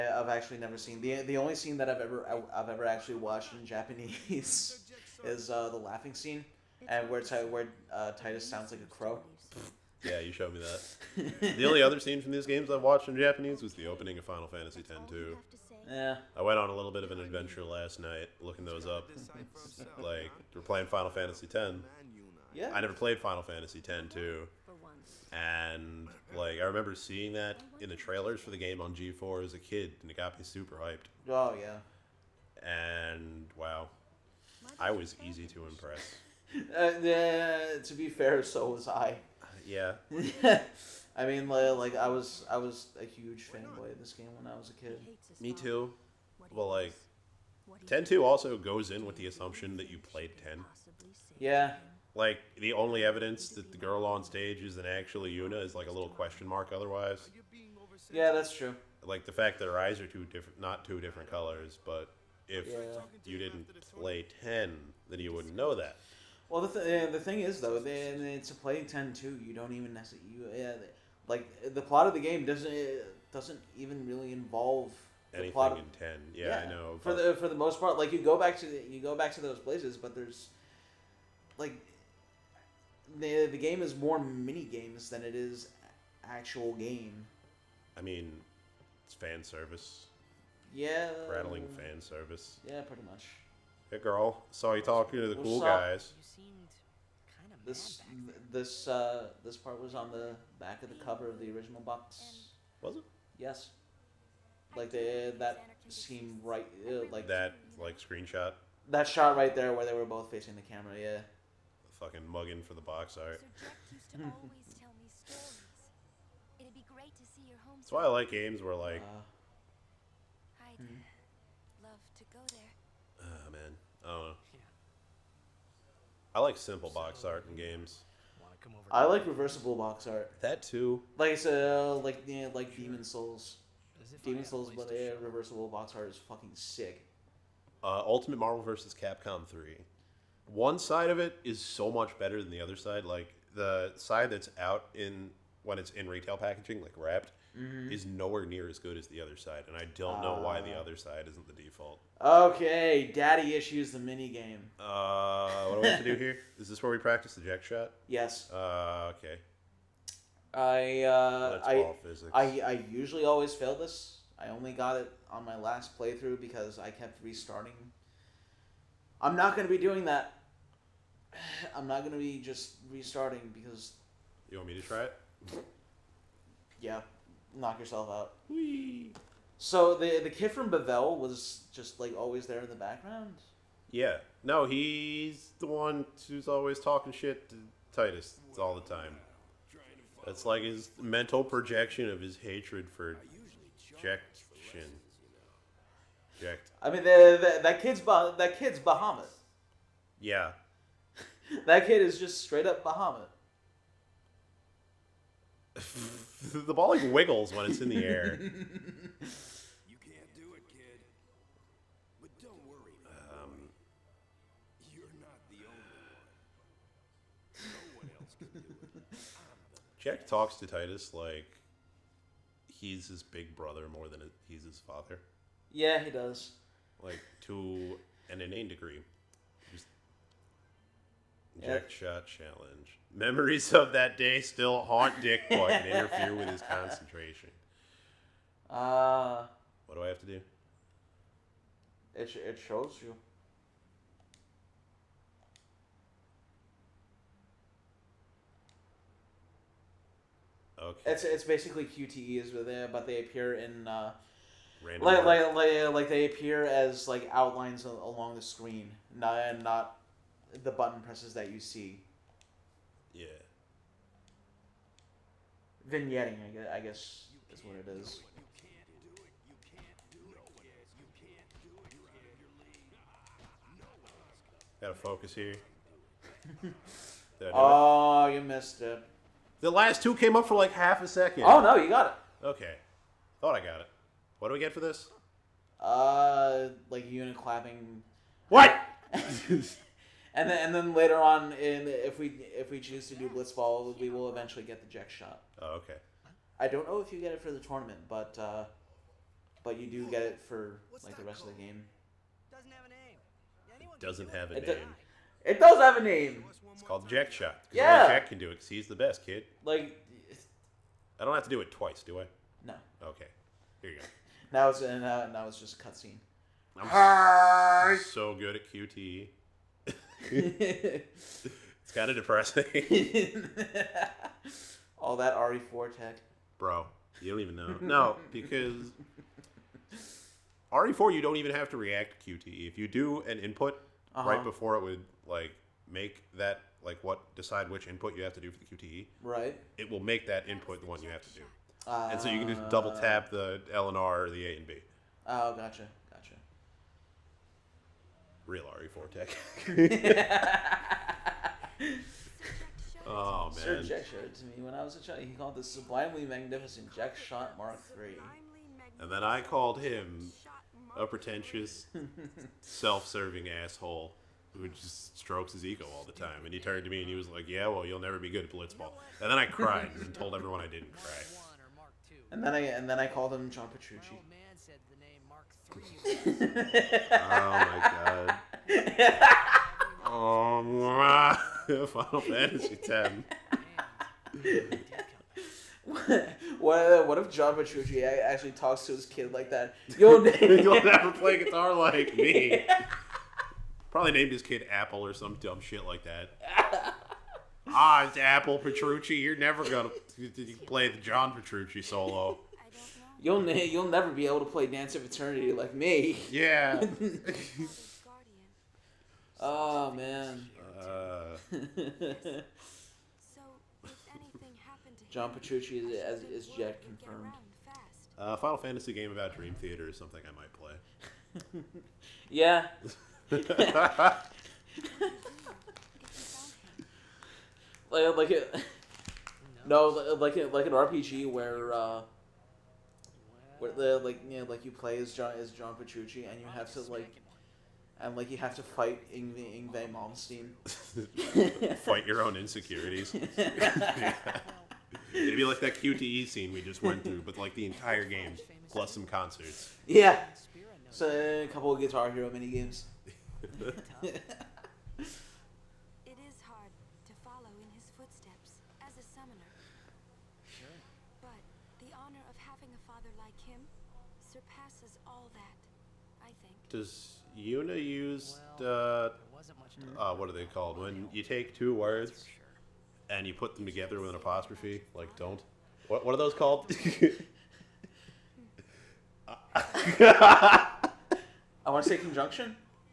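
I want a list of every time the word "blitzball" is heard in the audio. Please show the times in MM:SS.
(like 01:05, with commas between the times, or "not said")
04:53, 06:08.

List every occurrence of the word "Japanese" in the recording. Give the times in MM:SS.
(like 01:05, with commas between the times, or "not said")
00:03, 00:13.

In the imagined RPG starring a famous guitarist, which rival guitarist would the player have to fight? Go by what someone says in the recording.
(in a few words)
Yngwie Malmsteen.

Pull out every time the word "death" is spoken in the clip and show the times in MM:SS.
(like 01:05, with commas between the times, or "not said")
not said.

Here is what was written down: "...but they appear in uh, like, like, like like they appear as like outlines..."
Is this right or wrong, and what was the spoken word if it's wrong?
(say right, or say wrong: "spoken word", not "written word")
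right.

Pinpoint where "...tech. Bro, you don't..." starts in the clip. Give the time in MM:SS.
05:25.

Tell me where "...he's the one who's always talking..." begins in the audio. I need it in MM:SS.
03:04.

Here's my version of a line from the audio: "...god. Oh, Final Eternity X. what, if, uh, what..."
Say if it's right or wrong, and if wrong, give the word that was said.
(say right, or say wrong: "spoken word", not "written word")
wrong: "Fantasy", not "Eternity".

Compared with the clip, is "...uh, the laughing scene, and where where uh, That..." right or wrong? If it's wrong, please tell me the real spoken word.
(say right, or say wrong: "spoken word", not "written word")
wrong: "Tidus", not "That".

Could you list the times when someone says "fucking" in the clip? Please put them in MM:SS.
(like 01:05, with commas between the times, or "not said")
01:52, 02:16.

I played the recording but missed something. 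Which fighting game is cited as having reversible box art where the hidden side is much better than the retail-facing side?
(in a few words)
Ultimate Marvel vs. Capcom 3.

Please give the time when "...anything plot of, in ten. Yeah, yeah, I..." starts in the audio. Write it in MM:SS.
01:15.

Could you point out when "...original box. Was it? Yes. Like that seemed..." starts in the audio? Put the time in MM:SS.
01:41.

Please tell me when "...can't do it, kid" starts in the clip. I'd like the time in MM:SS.
03:29.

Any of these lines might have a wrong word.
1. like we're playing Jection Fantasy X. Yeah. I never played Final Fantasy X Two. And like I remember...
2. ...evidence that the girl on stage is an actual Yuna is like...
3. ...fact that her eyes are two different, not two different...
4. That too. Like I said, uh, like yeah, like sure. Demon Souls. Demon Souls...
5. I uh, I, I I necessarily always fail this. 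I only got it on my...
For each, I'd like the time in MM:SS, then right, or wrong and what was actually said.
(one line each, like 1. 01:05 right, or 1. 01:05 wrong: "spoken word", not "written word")
1. 00:19 wrong: "Final", not "Jection"
2. 00:53 right
3. 00:59 right
4. 02:10 right
5. 02:40 wrong: "usually", not "necessarily".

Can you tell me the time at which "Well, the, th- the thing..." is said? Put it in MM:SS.
01:06.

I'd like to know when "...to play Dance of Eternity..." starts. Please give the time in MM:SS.
06:44.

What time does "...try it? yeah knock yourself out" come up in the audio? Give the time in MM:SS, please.
02:54.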